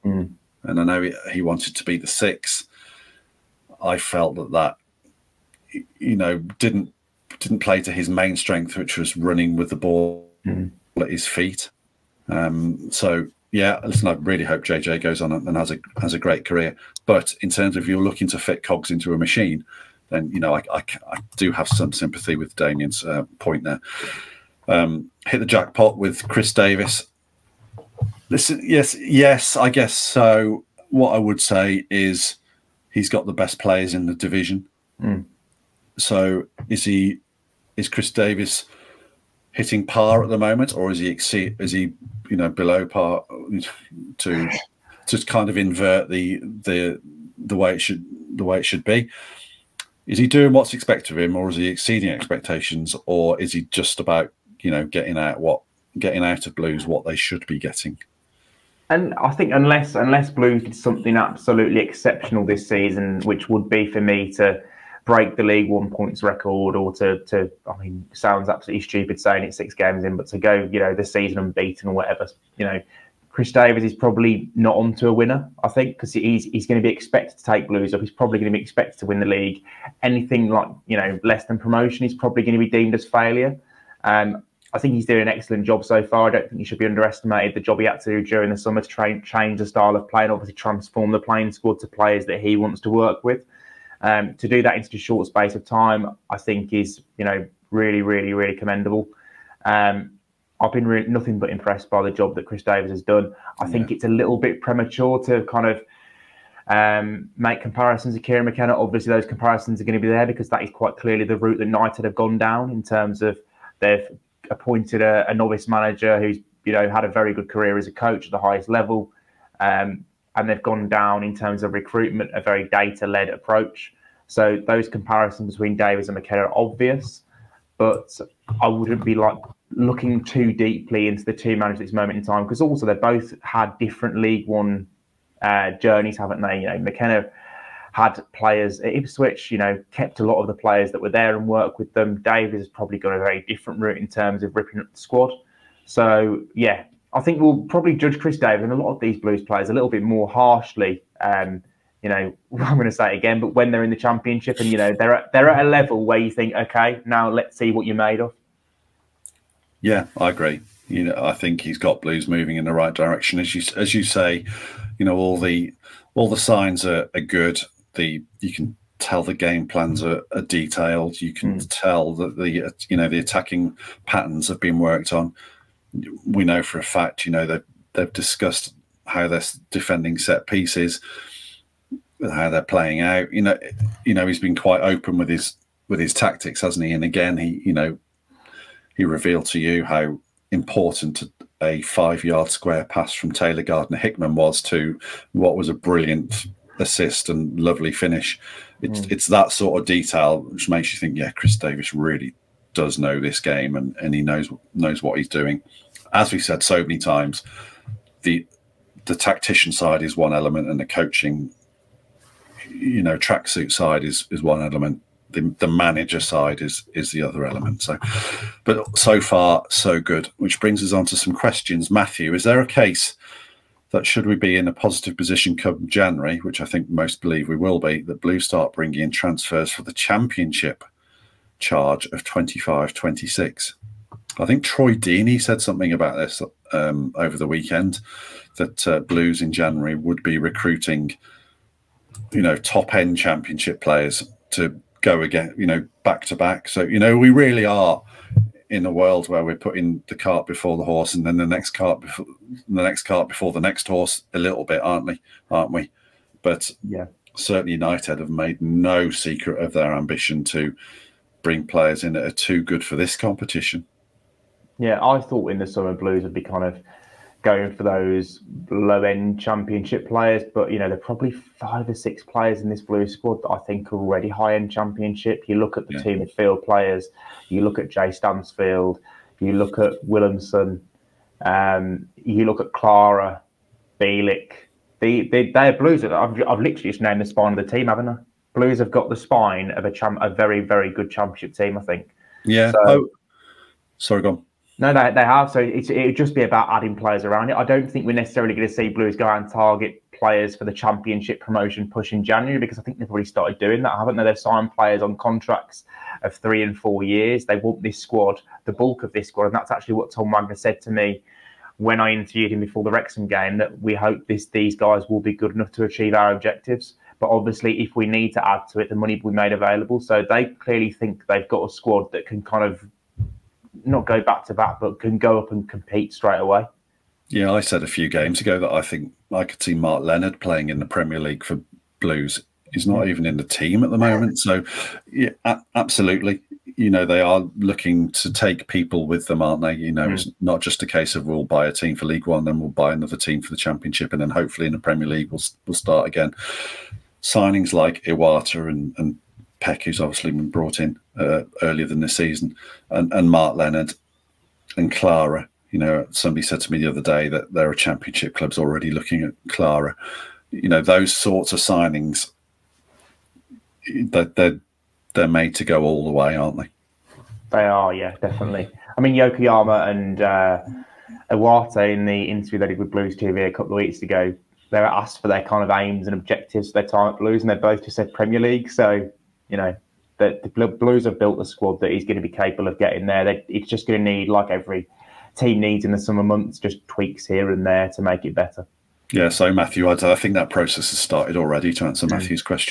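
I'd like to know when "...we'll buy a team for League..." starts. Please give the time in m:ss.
5:41.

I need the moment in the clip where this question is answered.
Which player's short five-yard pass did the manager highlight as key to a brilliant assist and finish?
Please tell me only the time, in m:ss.
3:13.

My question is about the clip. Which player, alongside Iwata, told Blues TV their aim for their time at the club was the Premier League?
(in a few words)
Yokoyama.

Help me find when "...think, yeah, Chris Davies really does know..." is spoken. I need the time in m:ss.
3:20.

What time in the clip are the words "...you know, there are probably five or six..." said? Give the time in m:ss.
4:30.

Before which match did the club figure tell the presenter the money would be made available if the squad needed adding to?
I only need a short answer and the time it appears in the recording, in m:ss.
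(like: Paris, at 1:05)
Wrexham, at 5:12.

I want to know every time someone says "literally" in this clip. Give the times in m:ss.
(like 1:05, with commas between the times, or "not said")
4:46.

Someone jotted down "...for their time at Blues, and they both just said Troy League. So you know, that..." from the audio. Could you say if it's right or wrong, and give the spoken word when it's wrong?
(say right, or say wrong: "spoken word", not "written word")
wrong: "Premier", not "Troy".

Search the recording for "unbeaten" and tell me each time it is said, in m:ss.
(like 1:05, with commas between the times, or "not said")
1:11.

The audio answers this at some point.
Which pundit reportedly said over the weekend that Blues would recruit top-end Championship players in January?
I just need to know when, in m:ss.
3:54.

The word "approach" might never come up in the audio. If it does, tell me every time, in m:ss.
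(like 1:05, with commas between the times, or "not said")
2:03.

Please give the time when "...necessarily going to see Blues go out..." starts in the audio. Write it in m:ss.
4:58.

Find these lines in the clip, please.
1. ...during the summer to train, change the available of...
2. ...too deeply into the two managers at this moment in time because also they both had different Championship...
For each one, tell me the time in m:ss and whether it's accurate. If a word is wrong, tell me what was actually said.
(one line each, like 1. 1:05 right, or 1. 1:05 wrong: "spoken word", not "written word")
1. 1:28 wrong: "style", not "available"
2. 2:10 wrong: "League", not "Championship".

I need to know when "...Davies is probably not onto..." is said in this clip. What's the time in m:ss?
1:13.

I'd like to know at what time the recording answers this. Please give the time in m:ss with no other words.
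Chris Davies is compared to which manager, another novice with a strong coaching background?
1:48.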